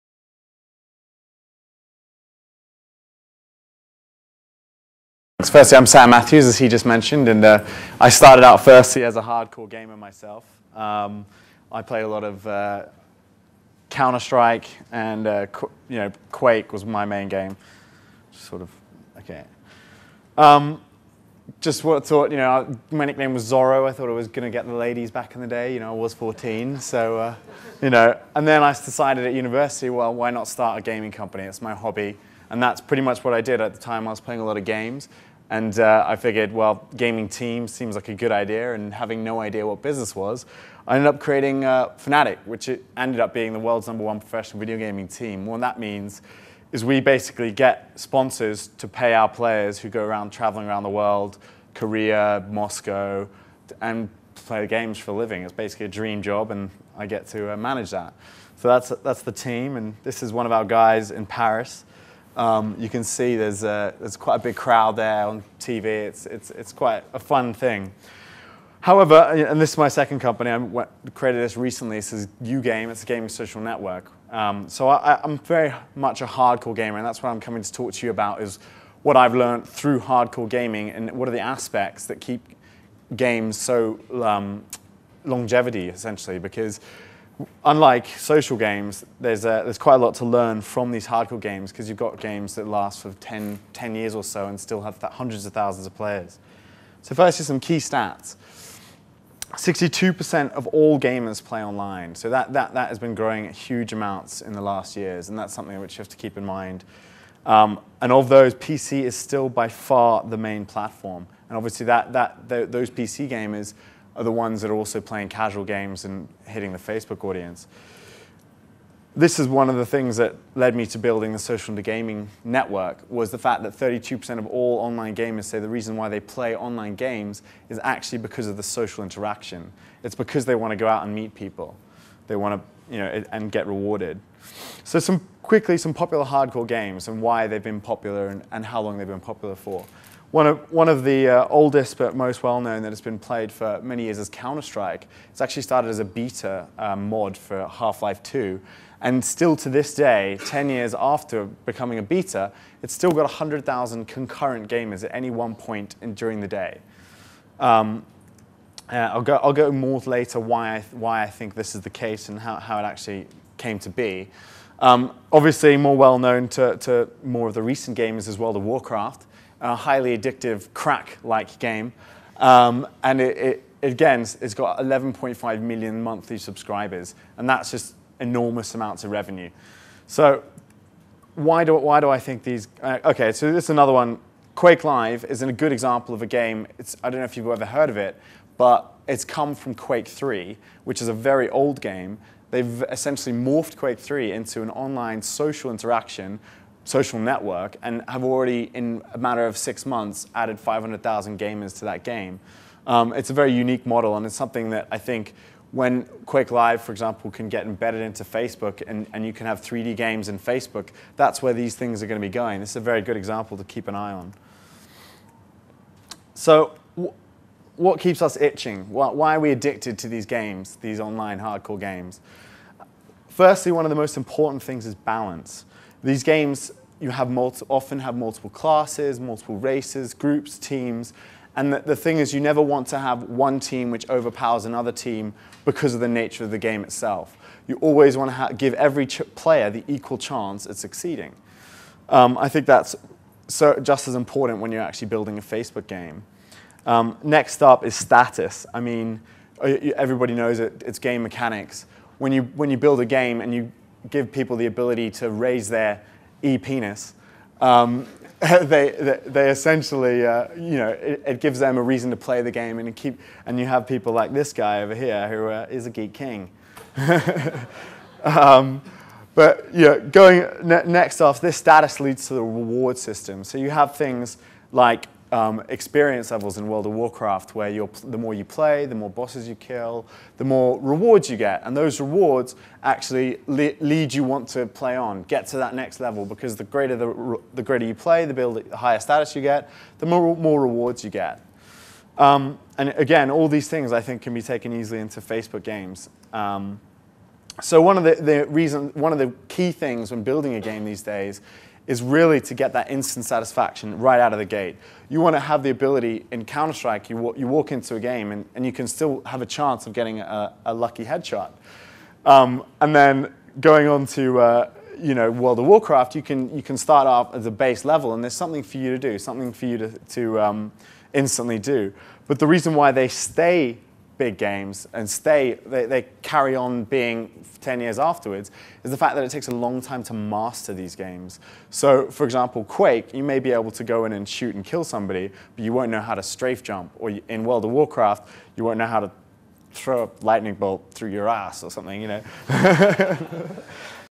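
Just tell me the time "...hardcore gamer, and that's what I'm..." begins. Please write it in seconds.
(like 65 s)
76 s.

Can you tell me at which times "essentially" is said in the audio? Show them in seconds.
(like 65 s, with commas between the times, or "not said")
85 s, 192 s, 259 s.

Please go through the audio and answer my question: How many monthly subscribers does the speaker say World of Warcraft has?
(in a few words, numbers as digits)
11.5 million.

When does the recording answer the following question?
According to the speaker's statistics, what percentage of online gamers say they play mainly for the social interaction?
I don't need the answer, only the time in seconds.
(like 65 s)
123 s.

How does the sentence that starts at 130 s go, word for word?
It's because they want to go out and meet people.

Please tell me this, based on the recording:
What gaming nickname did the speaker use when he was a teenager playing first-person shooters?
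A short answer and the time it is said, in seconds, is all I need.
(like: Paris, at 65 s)
Zorro, at 23 s.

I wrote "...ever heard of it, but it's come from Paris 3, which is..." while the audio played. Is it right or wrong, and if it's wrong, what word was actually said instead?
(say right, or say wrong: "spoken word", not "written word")
wrong: "Quake", not "Paris".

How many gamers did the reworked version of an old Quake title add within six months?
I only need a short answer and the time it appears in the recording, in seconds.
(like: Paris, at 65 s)
500,000, at 200 s.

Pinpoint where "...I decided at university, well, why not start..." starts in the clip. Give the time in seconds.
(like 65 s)
28 s.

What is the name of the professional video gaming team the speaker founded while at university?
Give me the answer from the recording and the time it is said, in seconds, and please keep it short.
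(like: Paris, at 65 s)
Fnatic, at 41 s.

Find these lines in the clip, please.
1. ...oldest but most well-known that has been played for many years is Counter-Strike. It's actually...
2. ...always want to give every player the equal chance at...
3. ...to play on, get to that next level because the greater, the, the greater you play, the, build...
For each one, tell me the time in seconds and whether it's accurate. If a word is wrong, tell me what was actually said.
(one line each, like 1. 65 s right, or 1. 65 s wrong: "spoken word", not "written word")
1. 141 s right
2. 237 s right
3. 284 s right.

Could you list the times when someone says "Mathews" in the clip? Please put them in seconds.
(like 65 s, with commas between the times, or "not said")
6 s.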